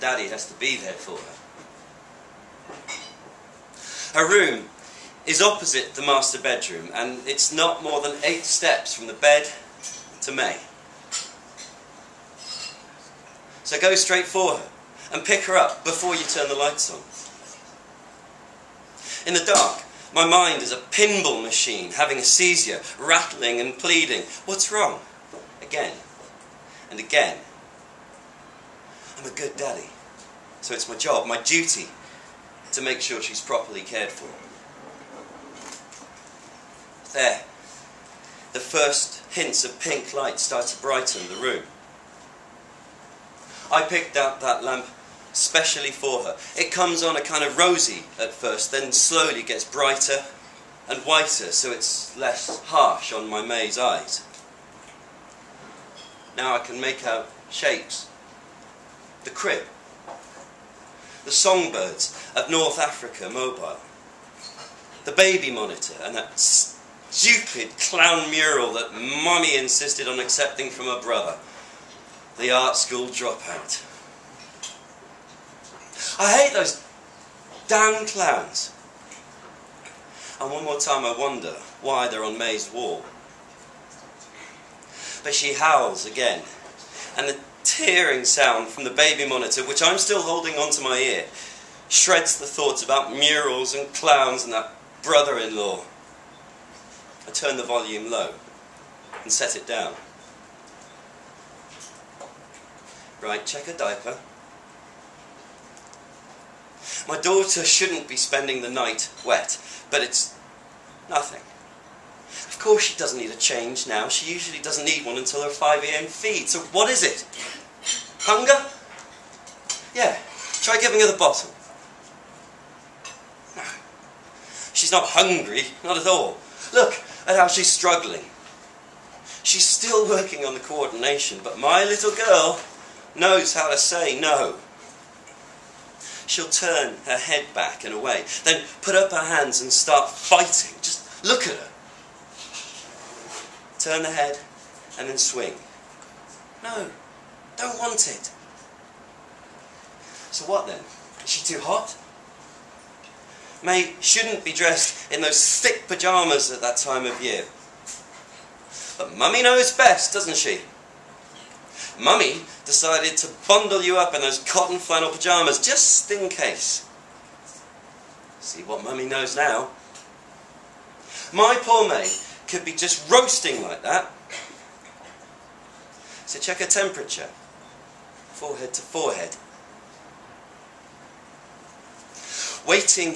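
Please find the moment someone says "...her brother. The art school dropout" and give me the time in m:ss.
1:10.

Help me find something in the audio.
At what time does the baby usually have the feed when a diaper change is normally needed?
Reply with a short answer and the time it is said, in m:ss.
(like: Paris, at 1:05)
5am, at 1:55.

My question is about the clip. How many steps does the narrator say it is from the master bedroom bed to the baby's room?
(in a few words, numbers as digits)
8.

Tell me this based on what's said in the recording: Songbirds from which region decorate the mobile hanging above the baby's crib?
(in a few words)
North Africa.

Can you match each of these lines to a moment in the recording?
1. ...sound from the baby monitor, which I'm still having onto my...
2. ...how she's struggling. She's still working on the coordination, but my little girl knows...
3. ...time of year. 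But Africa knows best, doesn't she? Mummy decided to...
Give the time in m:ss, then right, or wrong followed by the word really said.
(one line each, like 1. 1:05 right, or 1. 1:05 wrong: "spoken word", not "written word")
1. 1:28 wrong: "holding", not "having"
2. 2:07 right
3. 2:36 wrong: "Mummy", not "Africa".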